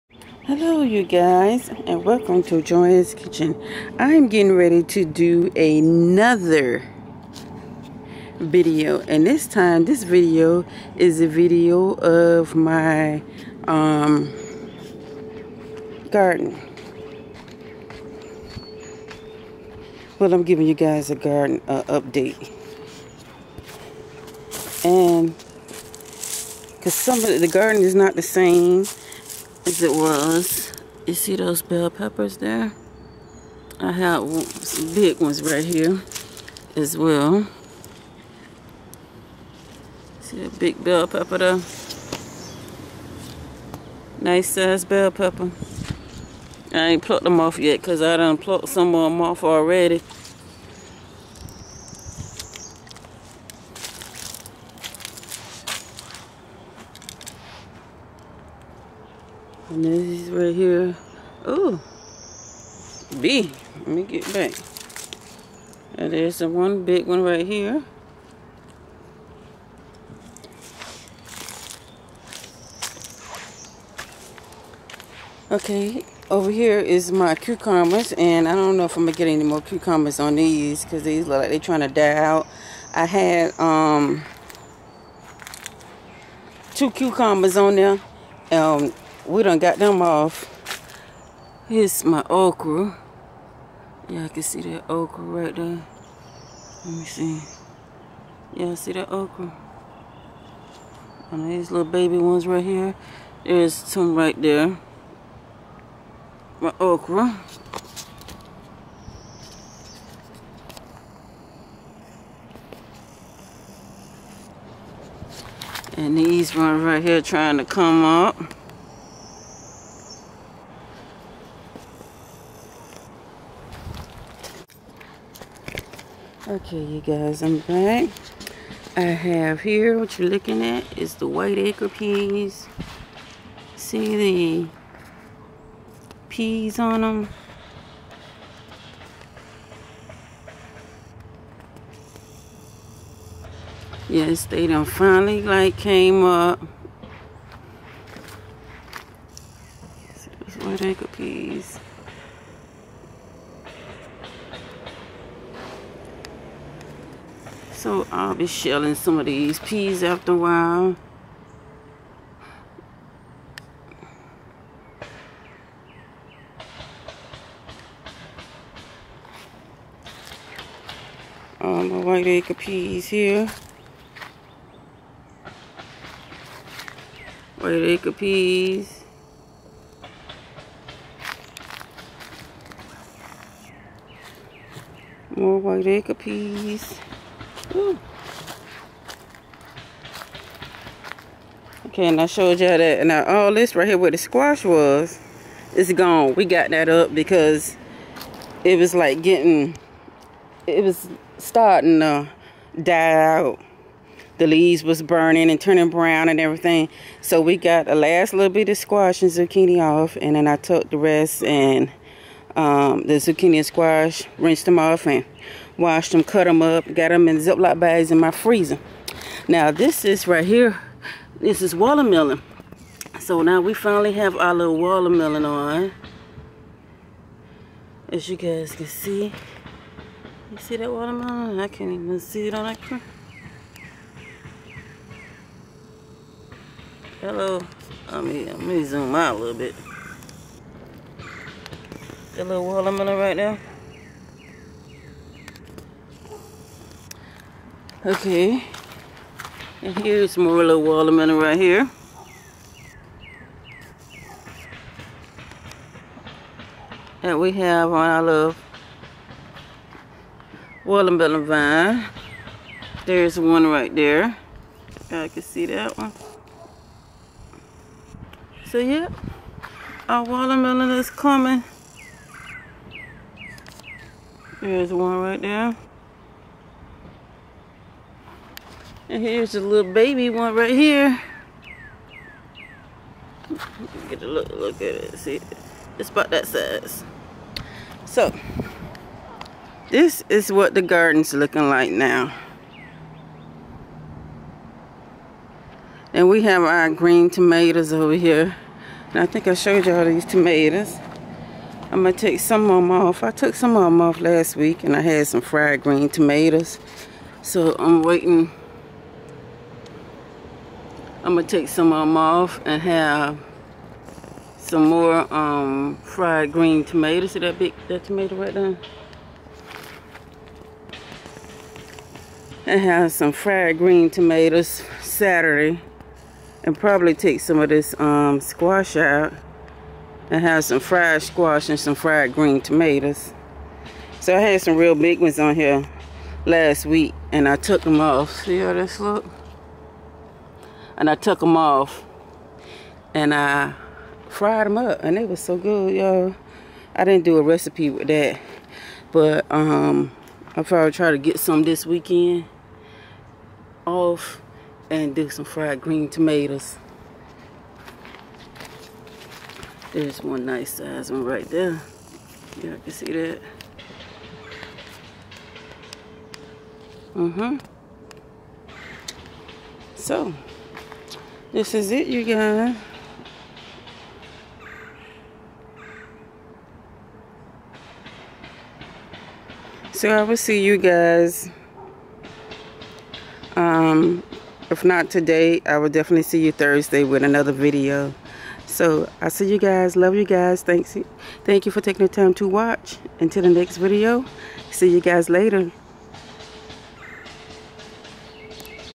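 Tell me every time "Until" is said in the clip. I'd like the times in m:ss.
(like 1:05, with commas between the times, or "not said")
6:33.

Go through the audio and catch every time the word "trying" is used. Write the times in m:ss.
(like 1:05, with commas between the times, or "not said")
1:21, 1:57.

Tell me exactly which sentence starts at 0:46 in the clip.
I ain't plucked them off yet because I done plucked some of them off already.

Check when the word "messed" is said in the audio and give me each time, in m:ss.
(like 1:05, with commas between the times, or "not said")
not said.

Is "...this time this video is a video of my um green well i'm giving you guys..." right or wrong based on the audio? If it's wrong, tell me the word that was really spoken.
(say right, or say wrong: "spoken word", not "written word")
wrong: "garden", not "green".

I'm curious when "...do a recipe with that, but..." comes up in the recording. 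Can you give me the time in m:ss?
5:47.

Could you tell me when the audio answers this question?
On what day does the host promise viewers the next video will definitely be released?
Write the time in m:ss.
6:26.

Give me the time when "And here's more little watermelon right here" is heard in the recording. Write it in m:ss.
4:09.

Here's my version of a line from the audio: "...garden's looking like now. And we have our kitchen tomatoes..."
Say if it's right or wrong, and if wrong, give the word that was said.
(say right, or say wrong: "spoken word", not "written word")
wrong: "green", not "kitchen".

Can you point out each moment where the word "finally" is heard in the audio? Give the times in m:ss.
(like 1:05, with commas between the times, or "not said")
2:24, 3:43.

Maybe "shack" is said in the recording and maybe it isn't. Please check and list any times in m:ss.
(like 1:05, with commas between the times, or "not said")
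not said.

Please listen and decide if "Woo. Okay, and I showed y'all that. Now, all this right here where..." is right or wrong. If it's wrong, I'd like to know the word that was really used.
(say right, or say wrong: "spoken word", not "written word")
right.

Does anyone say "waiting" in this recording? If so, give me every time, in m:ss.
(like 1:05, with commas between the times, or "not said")
5:08.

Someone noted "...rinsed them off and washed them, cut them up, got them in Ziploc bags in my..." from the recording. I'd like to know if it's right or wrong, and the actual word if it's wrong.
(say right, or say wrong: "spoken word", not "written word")
right.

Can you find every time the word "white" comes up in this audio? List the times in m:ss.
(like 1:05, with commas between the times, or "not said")
2:11, 2:30, 2:52, 2:57, 3:05.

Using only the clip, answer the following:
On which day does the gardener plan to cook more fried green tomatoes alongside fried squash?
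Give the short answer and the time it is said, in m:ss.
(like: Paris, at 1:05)
Saturday, at 5:25.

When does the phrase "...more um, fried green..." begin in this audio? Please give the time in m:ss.
5:14.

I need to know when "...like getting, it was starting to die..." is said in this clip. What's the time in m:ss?
3:18.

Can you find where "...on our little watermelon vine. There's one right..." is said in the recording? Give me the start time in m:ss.
4:17.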